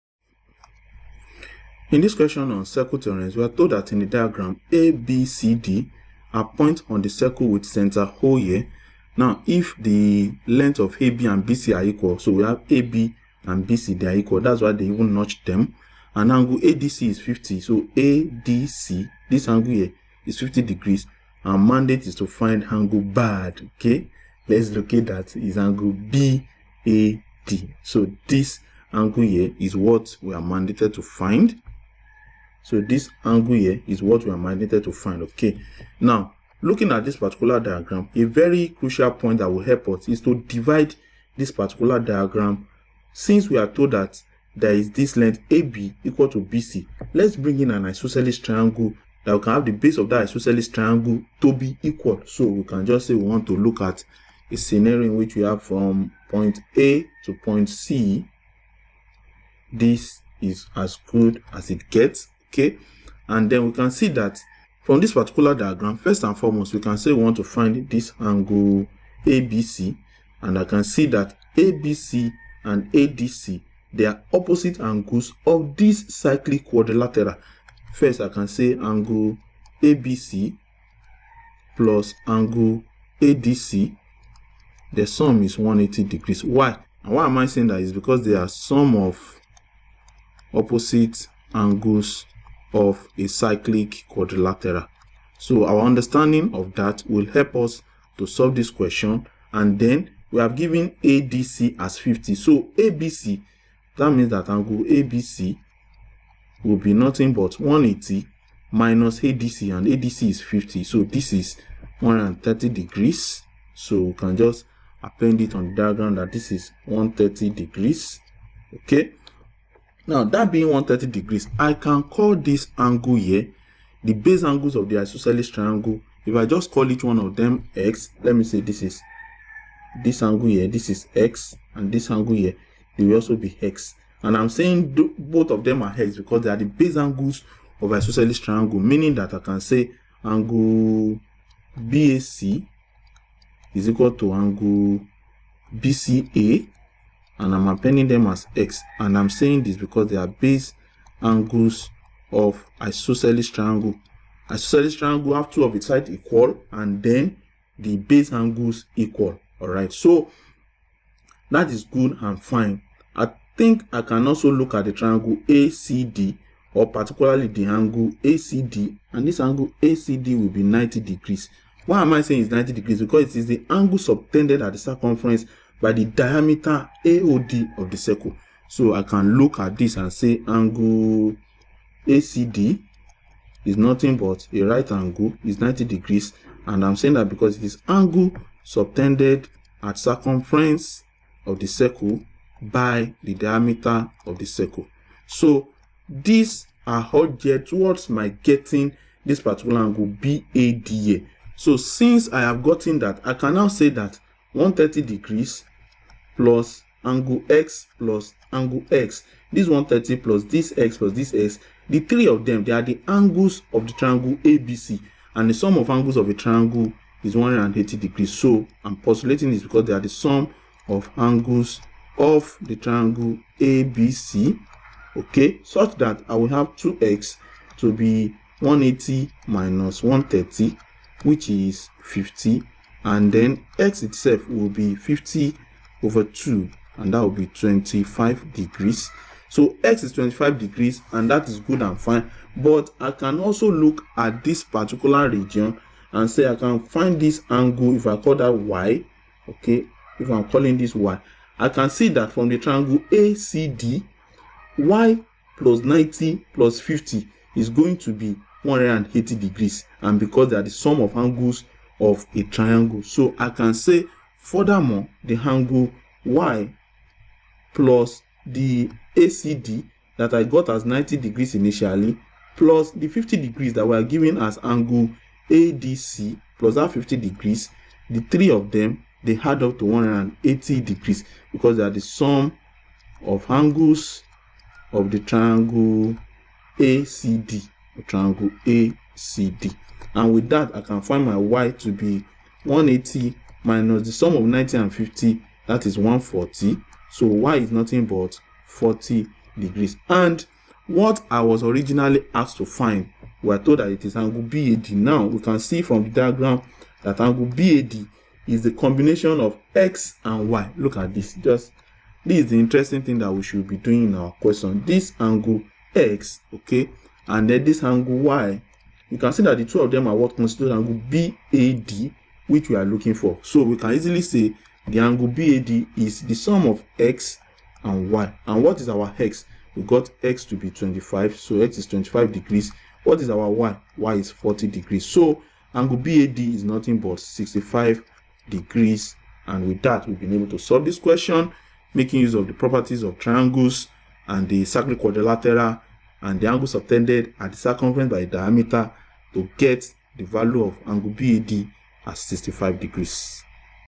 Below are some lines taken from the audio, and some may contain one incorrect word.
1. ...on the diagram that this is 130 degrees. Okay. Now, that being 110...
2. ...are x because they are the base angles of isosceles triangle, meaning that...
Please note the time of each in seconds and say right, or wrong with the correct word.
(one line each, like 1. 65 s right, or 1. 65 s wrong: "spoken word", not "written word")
1. 115 s wrong: "130", not "110"
2. 135 s right.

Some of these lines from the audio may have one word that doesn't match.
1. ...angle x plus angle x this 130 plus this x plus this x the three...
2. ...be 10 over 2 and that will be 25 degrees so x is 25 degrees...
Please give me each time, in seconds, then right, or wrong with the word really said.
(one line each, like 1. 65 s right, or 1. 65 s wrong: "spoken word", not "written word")
1. 207 s right
2. 234 s wrong: "50", not "10".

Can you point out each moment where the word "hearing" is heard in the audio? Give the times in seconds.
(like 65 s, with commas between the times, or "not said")
not said.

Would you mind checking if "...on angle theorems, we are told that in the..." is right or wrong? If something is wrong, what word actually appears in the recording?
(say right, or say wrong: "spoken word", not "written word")
wrong: "circle", not "angle".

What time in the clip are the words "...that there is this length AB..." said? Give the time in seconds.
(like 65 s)
43 s.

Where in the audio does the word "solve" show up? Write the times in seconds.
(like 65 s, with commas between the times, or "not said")
98 s, 340 s.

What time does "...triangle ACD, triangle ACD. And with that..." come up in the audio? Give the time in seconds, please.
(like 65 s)
285 s.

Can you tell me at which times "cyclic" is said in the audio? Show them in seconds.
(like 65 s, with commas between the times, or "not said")
76 s, 93 s.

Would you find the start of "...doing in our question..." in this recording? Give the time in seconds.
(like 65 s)
313 s.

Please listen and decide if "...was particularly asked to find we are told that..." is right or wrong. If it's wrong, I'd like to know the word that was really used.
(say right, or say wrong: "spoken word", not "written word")
wrong: "originally", not "particularly".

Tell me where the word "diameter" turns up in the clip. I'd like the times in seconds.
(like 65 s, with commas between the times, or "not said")
176 s, 193 s, 348 s.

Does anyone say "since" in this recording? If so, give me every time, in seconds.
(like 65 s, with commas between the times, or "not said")
43 s, 201 s.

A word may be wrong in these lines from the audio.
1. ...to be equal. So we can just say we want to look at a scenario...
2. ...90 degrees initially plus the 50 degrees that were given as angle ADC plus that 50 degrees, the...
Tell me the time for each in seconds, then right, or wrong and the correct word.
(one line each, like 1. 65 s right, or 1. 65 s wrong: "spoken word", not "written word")
1. 51 s right
2. 270 s right.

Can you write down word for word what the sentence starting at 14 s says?
That's why they even notch them.